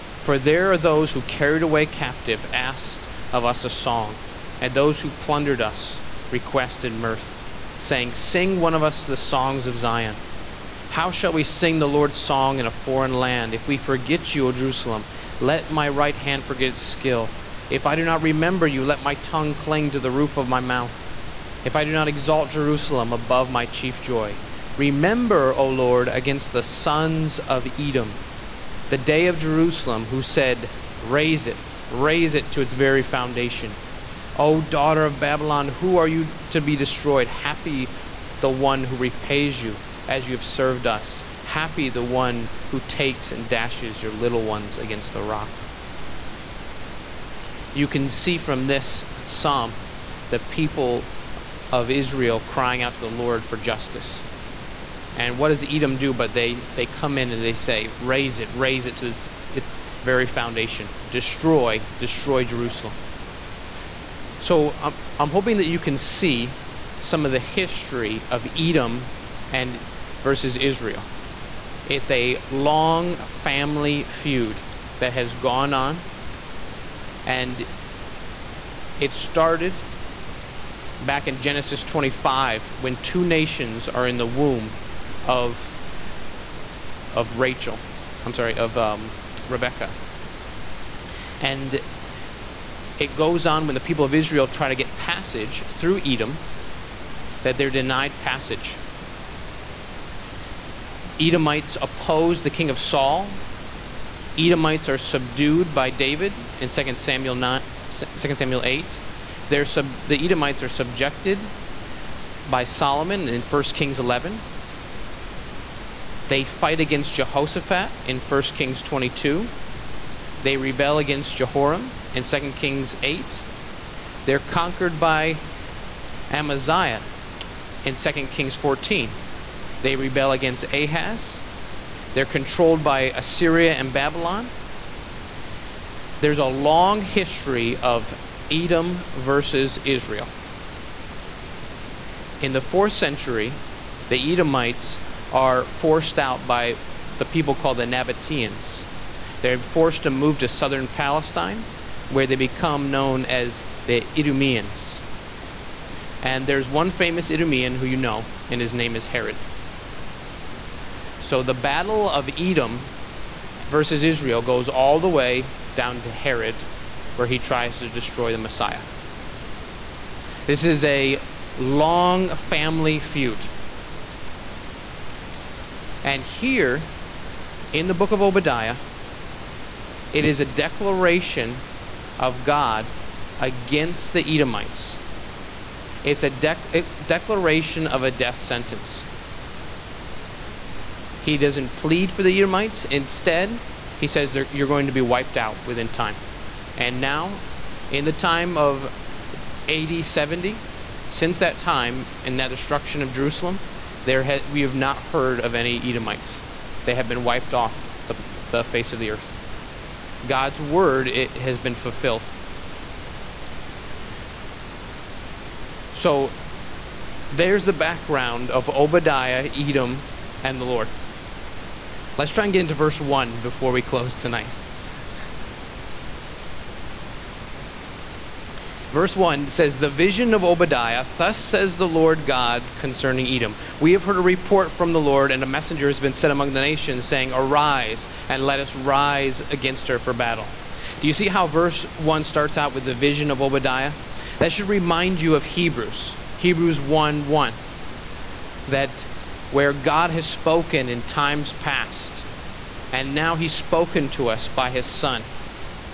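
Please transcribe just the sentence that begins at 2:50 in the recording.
This is a long family feud.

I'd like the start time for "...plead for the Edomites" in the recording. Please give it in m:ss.
3:11.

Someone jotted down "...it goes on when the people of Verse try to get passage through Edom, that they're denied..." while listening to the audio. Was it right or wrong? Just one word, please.
wrong.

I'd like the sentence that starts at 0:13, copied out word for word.
If we forget you, O Jerusalem, let my right hand forget its skill.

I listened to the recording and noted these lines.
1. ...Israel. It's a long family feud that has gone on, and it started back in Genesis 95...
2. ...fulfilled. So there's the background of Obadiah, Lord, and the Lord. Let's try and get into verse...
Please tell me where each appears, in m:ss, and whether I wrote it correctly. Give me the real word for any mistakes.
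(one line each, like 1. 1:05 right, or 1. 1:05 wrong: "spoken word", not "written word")
1. 1:10 wrong: "25", not "95"
2. 3:31 wrong: "Edom", not "Lord".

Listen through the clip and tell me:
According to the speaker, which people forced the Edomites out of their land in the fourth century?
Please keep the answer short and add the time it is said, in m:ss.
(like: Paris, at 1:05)
Nabateans, at 2:27.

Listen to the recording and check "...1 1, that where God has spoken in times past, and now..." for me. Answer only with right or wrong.
right.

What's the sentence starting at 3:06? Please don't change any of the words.
It's a, dec a declaration of a death sentence.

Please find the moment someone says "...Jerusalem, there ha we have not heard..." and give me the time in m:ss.
3:23.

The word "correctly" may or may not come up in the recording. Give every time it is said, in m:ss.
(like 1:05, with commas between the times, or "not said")
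not said.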